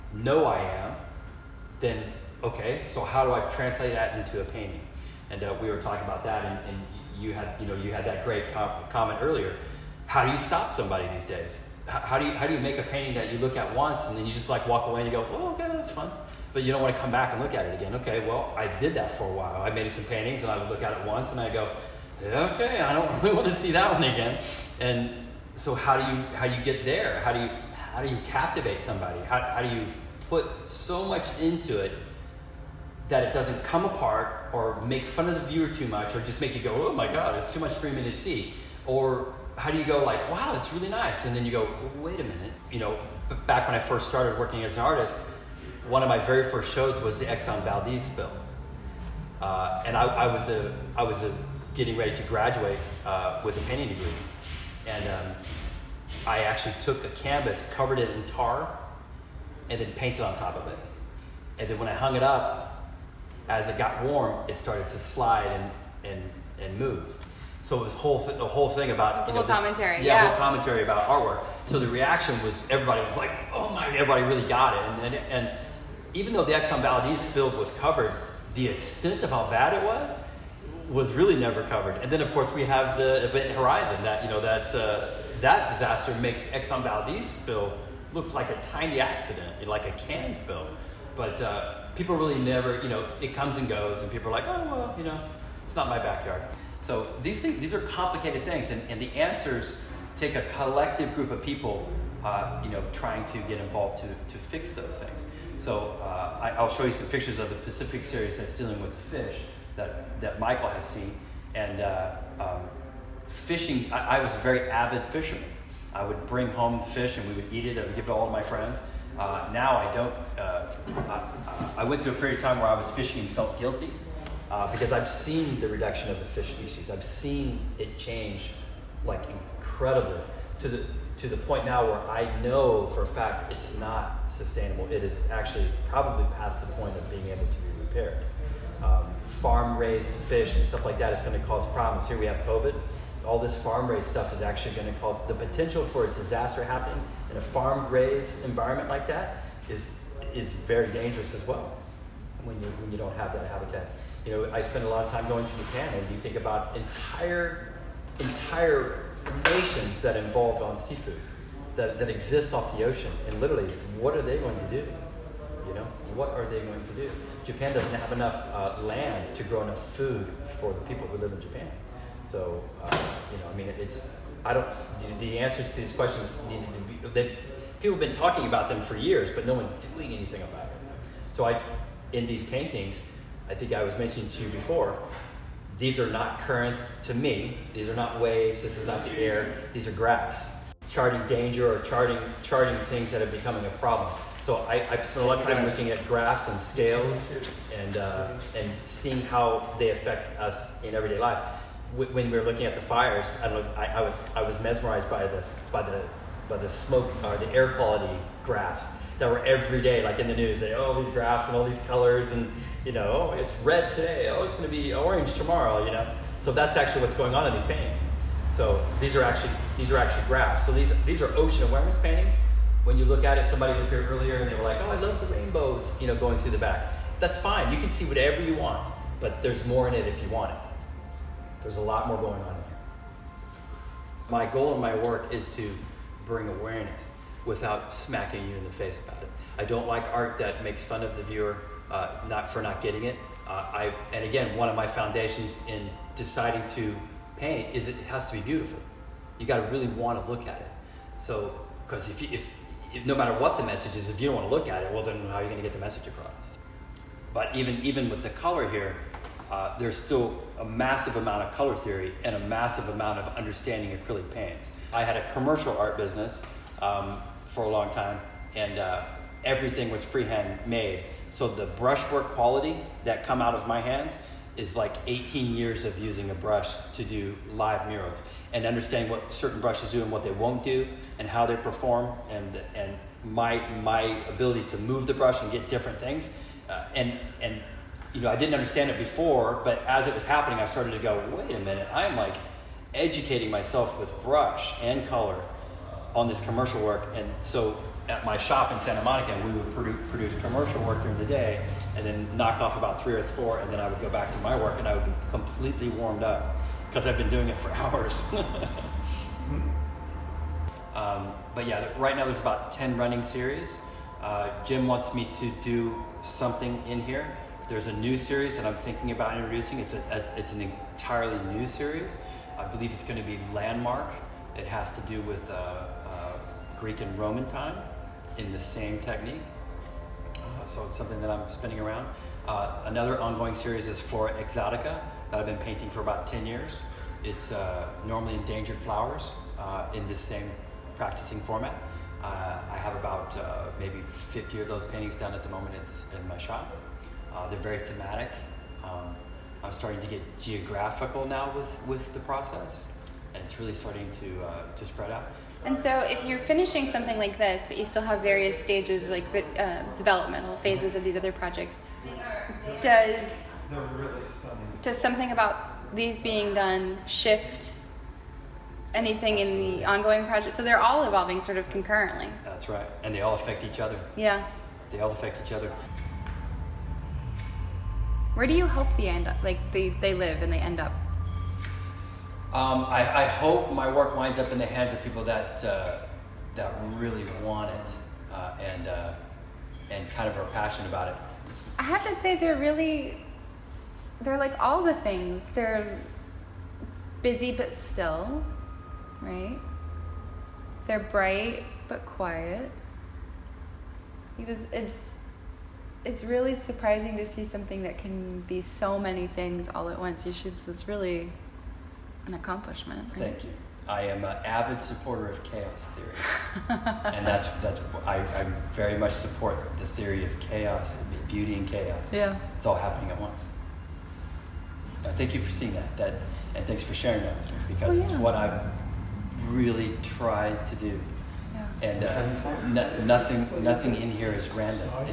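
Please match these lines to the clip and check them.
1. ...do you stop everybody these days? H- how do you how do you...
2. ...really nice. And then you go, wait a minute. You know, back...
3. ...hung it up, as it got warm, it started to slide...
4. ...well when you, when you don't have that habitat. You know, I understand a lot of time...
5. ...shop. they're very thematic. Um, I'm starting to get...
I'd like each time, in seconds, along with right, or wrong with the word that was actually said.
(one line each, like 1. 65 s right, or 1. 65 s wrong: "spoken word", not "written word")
1. 10 s wrong: "somebody", not "everybody"
2. 40 s right
3. 61 s right
4. 151 s wrong: "spend", not "understand"
5. 346 s right.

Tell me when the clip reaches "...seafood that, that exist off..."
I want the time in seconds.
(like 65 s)
160 s.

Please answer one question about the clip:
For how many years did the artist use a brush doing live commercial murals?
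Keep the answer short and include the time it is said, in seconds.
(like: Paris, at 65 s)
18, at 275 s.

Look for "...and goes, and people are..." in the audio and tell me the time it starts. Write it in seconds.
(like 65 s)
93 s.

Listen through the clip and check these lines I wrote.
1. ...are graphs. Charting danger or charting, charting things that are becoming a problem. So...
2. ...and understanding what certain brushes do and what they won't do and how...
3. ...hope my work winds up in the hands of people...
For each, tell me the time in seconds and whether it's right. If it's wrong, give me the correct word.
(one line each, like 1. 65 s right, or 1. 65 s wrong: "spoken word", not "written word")
1. 189 s right
2. 278 s right
3. 383 s right.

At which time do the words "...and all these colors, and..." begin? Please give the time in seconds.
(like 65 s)
211 s.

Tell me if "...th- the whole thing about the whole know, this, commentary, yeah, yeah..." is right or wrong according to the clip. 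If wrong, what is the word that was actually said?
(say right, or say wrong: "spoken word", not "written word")
right.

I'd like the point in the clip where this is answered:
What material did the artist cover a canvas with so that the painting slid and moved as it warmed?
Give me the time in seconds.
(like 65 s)
58 s.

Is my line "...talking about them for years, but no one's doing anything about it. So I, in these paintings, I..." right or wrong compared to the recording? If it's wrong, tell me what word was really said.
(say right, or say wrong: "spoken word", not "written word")
right.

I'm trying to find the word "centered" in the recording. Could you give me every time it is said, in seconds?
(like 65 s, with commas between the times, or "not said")
not said.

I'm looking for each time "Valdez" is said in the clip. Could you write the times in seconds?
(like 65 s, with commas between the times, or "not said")
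47 s, 76 s, 86 s.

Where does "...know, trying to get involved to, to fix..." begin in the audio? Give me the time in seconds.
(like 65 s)
102 s.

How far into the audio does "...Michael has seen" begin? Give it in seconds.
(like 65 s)
110 s.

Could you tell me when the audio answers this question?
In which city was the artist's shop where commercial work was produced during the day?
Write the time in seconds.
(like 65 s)
298 s.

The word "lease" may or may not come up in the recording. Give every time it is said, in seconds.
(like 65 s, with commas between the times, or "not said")
not said.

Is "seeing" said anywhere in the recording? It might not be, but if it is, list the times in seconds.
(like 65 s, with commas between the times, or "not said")
198 s, 425 s.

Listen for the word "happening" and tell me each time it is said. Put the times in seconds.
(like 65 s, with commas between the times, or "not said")
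146 s, 290 s, 422 s.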